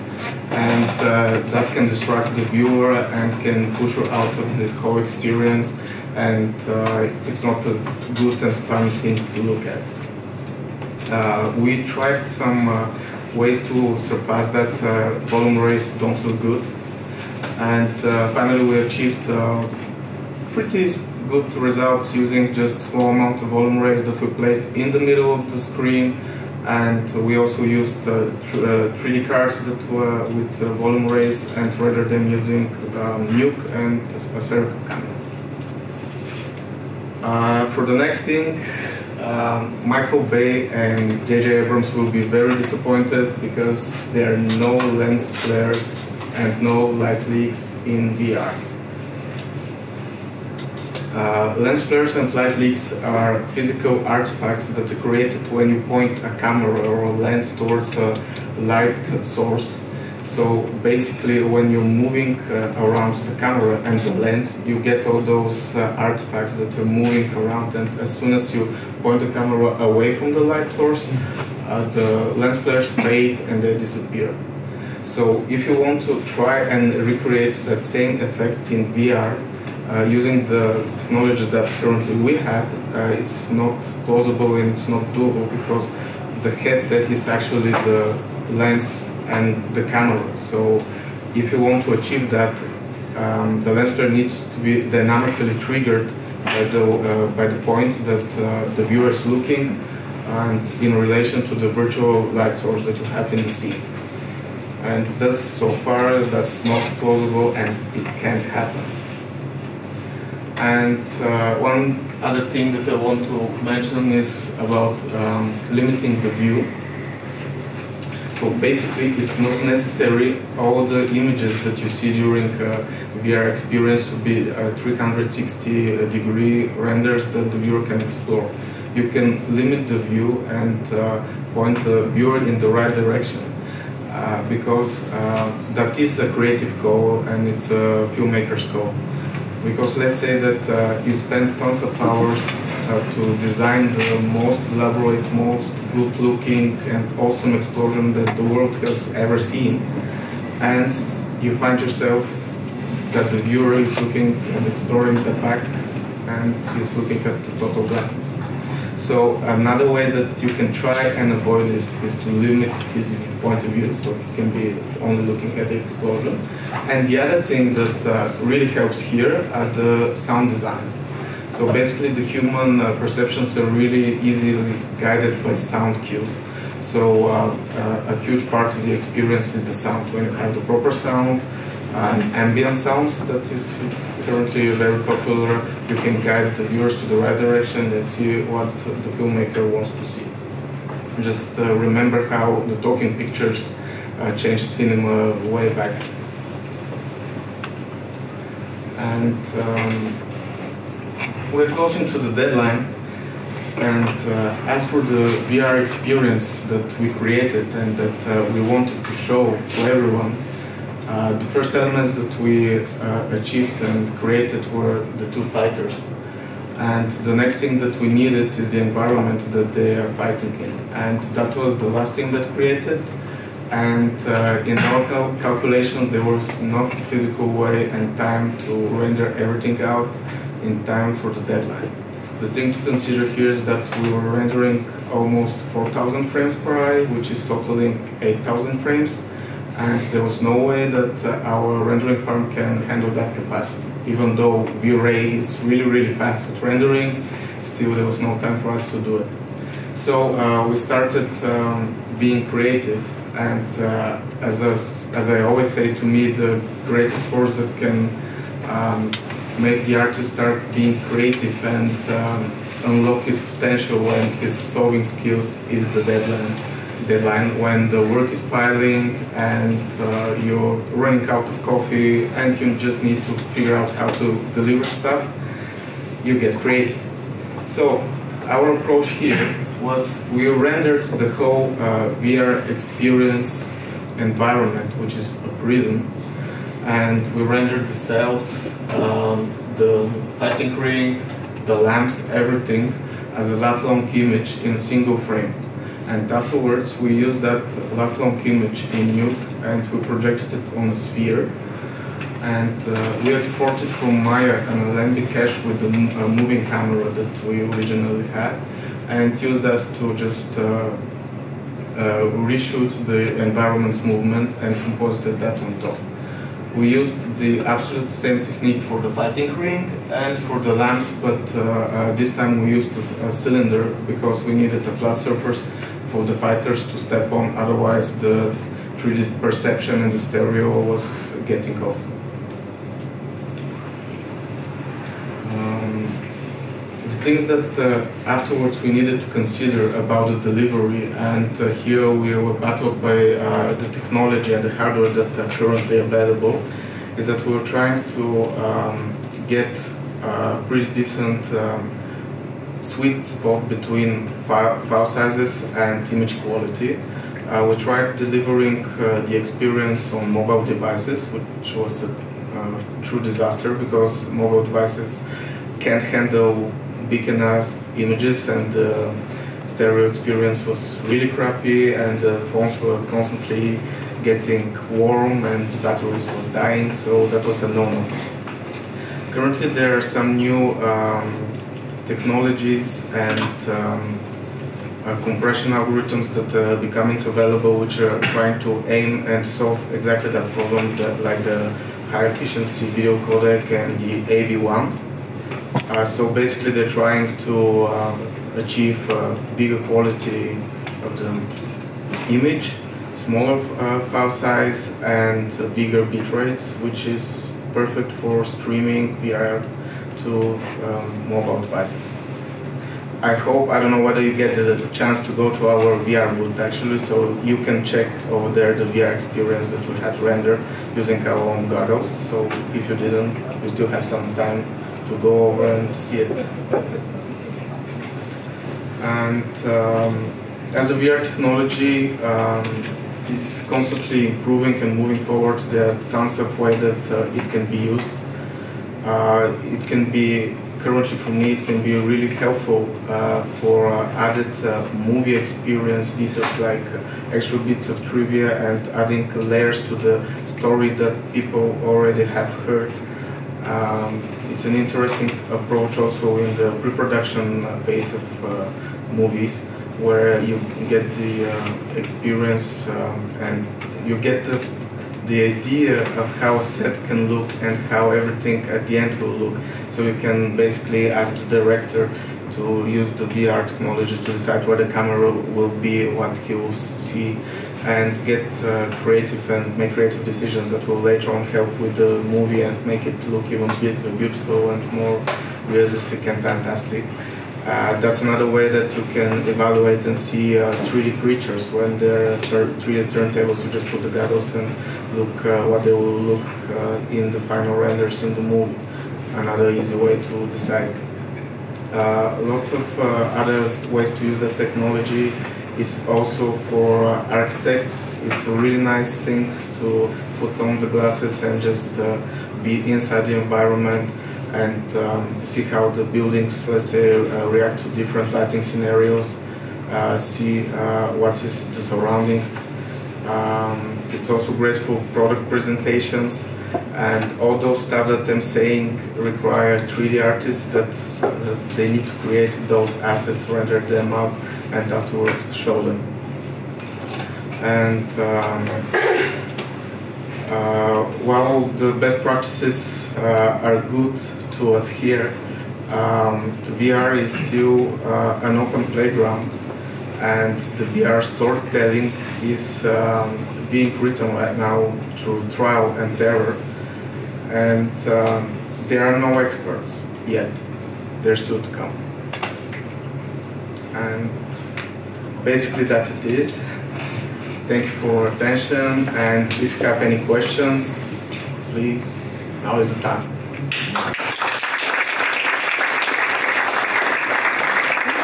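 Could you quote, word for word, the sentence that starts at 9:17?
And um, there are no experts yet.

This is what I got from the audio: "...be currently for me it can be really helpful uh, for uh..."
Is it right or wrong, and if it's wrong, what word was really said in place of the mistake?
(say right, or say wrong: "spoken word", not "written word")
right.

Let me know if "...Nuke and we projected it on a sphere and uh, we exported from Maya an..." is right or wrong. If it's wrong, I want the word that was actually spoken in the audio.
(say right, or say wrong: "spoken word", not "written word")
right.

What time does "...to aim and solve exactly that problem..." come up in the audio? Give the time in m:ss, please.
6:28.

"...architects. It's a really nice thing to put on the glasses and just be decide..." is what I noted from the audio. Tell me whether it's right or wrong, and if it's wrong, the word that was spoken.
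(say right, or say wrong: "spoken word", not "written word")
wrong: "inside", not "decide".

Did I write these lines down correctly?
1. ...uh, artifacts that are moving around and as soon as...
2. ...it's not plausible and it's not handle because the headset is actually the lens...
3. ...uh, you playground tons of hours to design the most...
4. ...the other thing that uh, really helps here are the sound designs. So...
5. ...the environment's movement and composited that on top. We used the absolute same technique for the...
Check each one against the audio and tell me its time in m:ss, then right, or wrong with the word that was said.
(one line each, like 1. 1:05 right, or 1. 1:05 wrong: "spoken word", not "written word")
1. 1:05 right
2. 1:23 wrong: "doable", not "handle"
3. 2:20 wrong: "spend", not "playground"
4. 2:47 right
5. 5:13 right.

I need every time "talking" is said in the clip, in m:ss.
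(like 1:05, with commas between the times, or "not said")
3:12.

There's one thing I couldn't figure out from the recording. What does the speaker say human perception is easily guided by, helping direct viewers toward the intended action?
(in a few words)
Sound cues.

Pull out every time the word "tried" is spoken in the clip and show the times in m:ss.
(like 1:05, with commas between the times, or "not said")
0:11, 5:57.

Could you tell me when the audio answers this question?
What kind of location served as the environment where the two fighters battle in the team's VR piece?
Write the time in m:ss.
4:45.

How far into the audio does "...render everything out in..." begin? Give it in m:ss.
3:48.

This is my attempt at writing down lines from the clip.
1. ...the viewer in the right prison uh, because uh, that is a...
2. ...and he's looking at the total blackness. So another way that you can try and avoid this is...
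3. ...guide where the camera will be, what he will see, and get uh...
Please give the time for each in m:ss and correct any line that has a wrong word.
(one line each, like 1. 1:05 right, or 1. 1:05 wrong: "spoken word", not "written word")
1. 2:11 wrong: "direction", not "prison"
2. 2:36 right
3. 7:54 wrong: "decide", not "guide".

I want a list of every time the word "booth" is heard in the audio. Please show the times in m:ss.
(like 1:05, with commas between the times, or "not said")
6:56.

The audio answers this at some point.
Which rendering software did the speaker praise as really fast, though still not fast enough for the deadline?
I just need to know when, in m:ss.
4:04.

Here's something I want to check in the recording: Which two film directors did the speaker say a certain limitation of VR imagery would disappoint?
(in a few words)
Michael Bay and JJ Abrams.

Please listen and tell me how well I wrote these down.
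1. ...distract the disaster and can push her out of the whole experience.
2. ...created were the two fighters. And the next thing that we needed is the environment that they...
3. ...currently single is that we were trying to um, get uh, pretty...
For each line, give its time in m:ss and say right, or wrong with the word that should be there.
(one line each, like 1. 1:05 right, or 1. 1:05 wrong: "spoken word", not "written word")
1. 0:01 wrong: "viewer", not "disaster"
2. 3:34 right
3. 5:45 wrong: "available", not "single".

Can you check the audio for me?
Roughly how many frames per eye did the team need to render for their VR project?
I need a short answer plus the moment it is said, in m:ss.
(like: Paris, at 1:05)
4,000, at 3:55.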